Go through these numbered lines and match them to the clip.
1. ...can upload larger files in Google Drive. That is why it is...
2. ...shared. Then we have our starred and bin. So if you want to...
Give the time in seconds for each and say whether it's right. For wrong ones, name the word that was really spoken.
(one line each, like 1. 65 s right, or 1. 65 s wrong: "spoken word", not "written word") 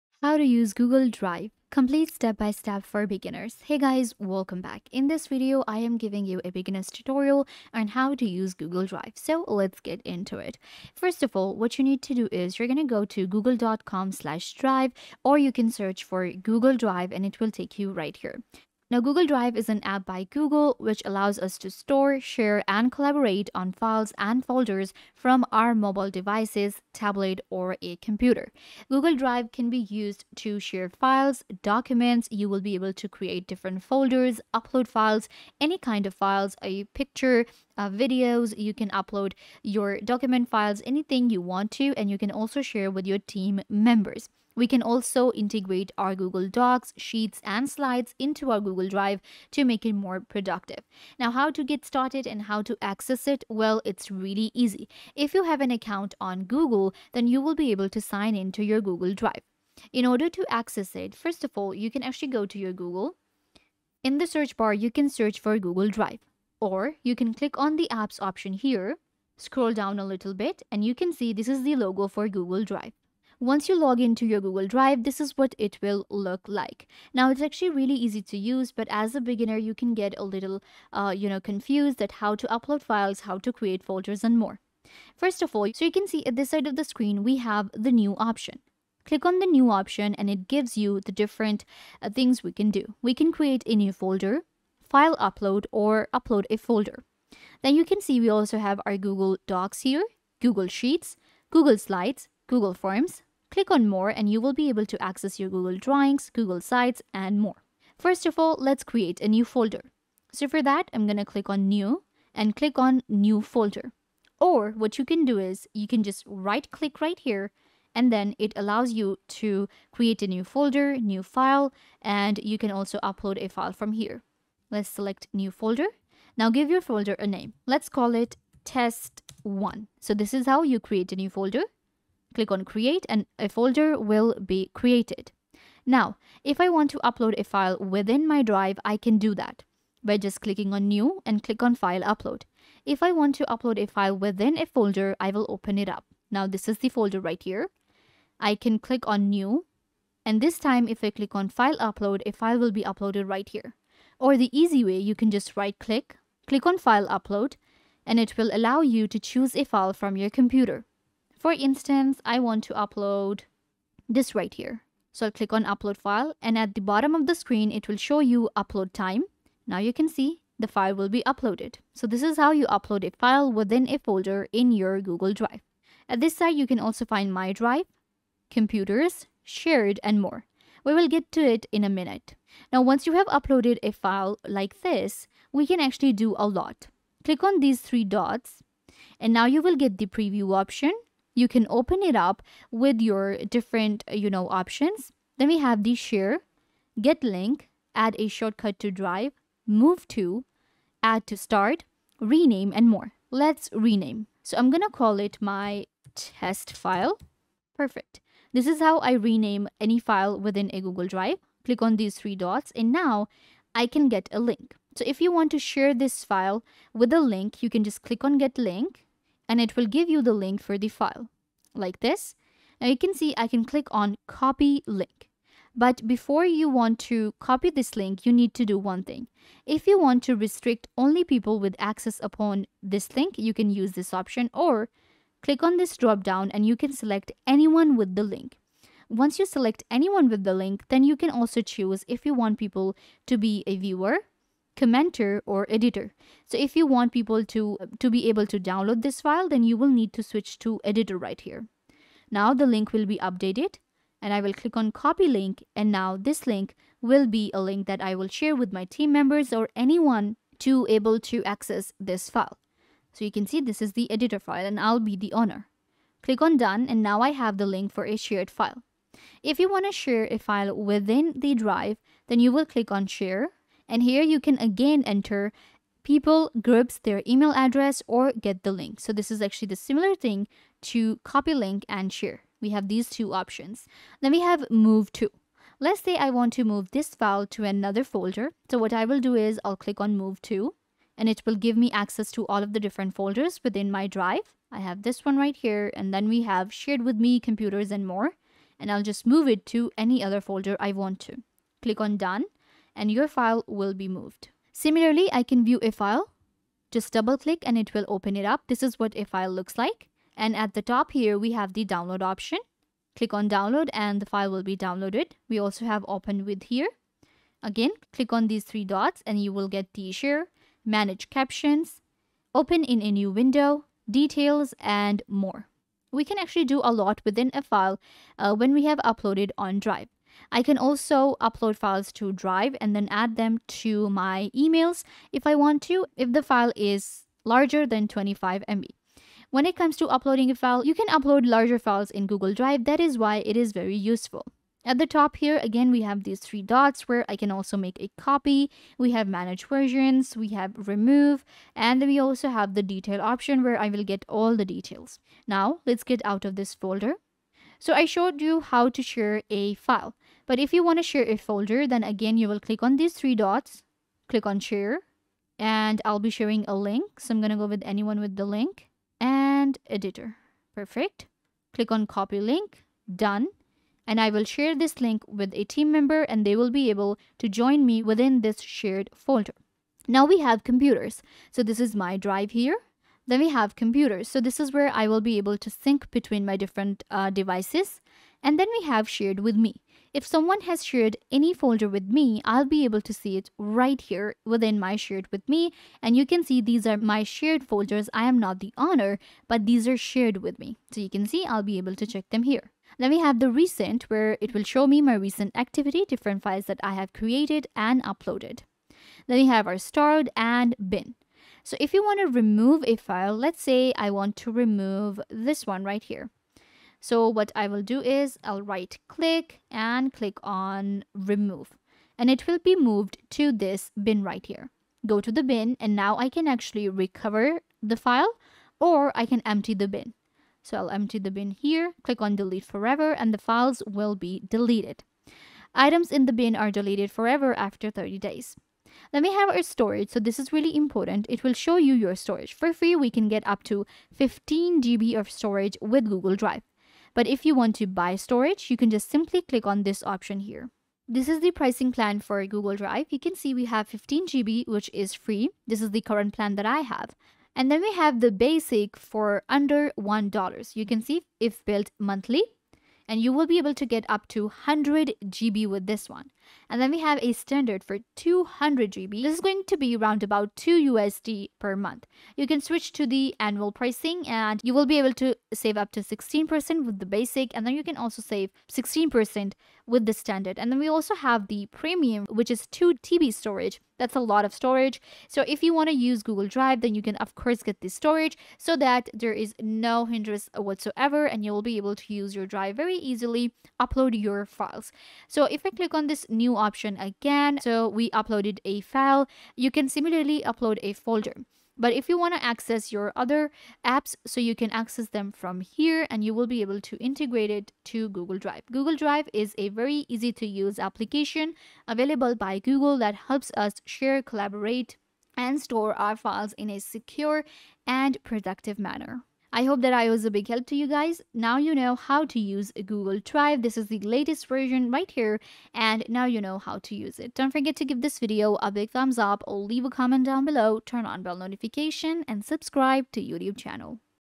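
1. 340 s right
2. 408 s wrong: "uploaded", not "shared".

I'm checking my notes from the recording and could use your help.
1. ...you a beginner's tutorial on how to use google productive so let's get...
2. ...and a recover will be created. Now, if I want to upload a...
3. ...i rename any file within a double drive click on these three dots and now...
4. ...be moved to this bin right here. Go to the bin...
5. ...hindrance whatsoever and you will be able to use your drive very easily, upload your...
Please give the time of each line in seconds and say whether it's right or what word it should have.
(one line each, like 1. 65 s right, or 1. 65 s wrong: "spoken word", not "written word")
1. 6 s wrong: "drive", not "productive"
2. 133 s wrong: "folder", not "recover"
3. 208 s wrong: "google", not "double"
4. 422 s right
5. 490 s right.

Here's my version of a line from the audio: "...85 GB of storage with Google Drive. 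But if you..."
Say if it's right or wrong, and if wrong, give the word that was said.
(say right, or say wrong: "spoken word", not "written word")
wrong: "15", not "85".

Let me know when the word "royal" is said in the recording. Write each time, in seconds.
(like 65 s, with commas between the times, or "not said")
not said.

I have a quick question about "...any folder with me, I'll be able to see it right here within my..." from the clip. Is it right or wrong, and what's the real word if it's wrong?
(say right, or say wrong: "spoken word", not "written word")
right.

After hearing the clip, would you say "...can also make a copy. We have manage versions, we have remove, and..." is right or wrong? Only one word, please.
right.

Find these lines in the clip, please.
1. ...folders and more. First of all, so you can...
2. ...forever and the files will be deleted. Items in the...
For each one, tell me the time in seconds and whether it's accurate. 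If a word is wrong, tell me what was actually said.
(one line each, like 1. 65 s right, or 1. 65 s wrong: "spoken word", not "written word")
1. 83 s right
2. 432 s right.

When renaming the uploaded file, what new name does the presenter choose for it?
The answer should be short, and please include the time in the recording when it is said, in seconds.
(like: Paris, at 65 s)
my test file, at 205 s.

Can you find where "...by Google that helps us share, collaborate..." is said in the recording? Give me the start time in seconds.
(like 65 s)
512 s.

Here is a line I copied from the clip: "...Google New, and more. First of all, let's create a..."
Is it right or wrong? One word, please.
wrong.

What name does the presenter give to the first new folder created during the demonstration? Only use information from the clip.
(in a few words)
test1.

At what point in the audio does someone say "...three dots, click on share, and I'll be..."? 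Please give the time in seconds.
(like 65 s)
363 s.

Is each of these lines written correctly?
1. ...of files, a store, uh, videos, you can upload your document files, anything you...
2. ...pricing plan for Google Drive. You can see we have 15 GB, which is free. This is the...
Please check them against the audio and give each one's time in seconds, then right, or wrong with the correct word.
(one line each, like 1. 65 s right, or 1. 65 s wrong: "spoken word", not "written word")
1. 36 s wrong: "picture", not "store"
2. 451 s right.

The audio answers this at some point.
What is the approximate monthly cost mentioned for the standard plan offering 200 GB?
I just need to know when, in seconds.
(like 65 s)
470 s.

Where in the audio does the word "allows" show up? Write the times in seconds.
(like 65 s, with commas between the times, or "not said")
21 s, 118 s, 158 s.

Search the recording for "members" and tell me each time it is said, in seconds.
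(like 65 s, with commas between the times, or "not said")
43 s, 259 s, 375 s.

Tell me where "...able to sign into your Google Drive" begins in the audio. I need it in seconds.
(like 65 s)
57 s.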